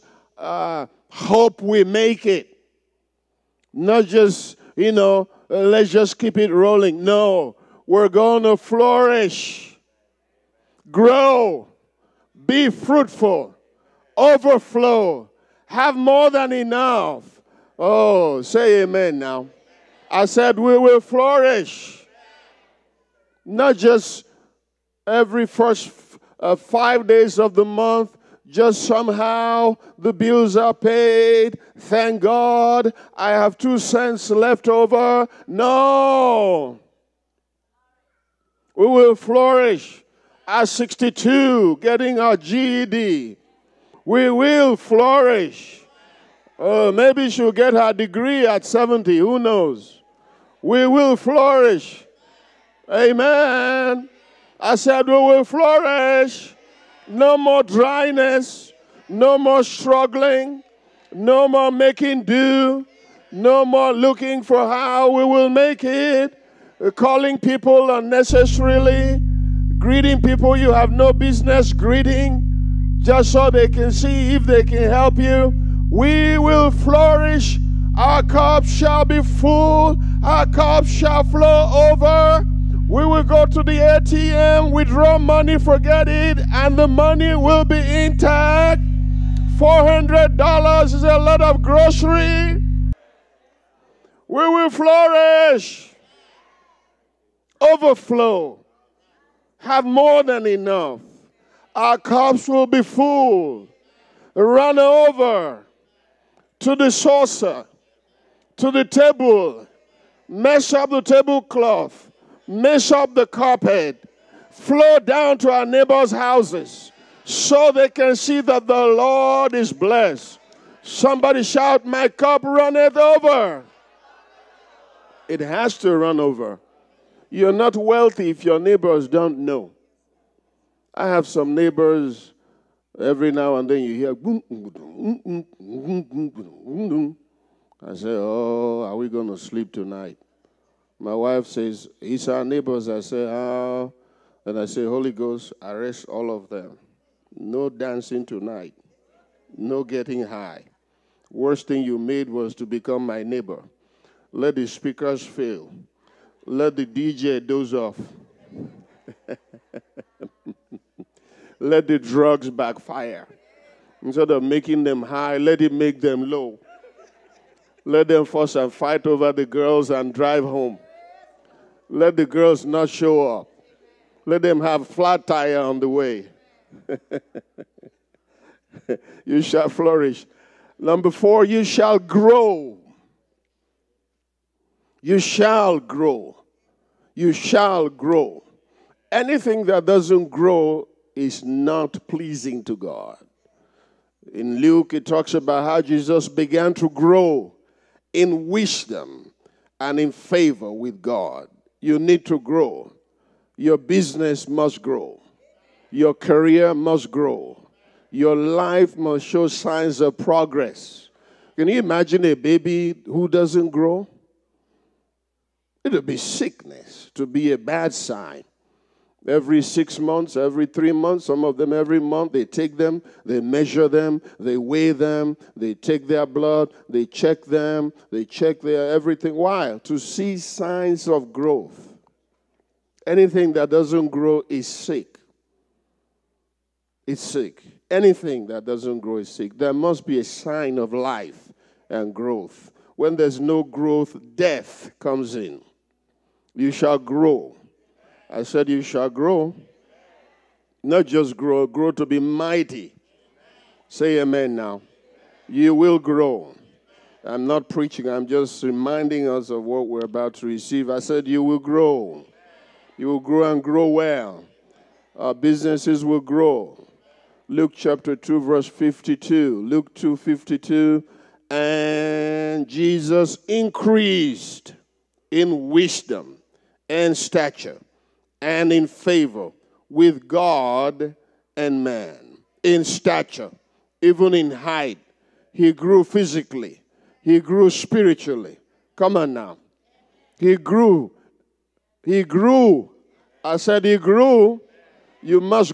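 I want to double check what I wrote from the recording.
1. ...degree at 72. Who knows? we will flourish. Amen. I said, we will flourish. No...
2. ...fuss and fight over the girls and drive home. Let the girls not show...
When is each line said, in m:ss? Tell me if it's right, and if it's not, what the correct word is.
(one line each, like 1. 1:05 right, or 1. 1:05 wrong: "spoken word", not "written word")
1. 0:47 wrong: "70", not "72"
2. 2:48 right.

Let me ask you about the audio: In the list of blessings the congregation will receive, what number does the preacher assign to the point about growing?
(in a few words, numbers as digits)
4.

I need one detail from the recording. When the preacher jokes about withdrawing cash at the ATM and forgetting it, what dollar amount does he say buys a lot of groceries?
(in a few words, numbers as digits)
$400.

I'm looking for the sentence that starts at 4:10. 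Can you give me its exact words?
Not just grow, grow to be mighty.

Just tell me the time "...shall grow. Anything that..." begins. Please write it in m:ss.
3:07.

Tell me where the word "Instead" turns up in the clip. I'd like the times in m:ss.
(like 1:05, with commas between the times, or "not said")
2:44.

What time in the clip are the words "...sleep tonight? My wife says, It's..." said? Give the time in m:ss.
2:19.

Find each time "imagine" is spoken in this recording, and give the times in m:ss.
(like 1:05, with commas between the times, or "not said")
3:31.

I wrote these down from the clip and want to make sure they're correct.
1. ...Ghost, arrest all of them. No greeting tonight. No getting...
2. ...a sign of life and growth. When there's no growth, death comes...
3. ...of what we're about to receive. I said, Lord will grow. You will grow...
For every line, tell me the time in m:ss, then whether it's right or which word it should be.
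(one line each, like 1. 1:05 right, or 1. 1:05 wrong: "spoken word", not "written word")
1. 2:25 wrong: "dancing", not "greeting"
2. 4:00 right
3. 4:19 wrong: "You", not "Lord".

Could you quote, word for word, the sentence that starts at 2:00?
Somebody shout, My cup runneth over.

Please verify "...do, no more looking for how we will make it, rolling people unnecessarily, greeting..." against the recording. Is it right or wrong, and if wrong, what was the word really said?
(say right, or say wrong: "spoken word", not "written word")
wrong: "calling", not "rolling".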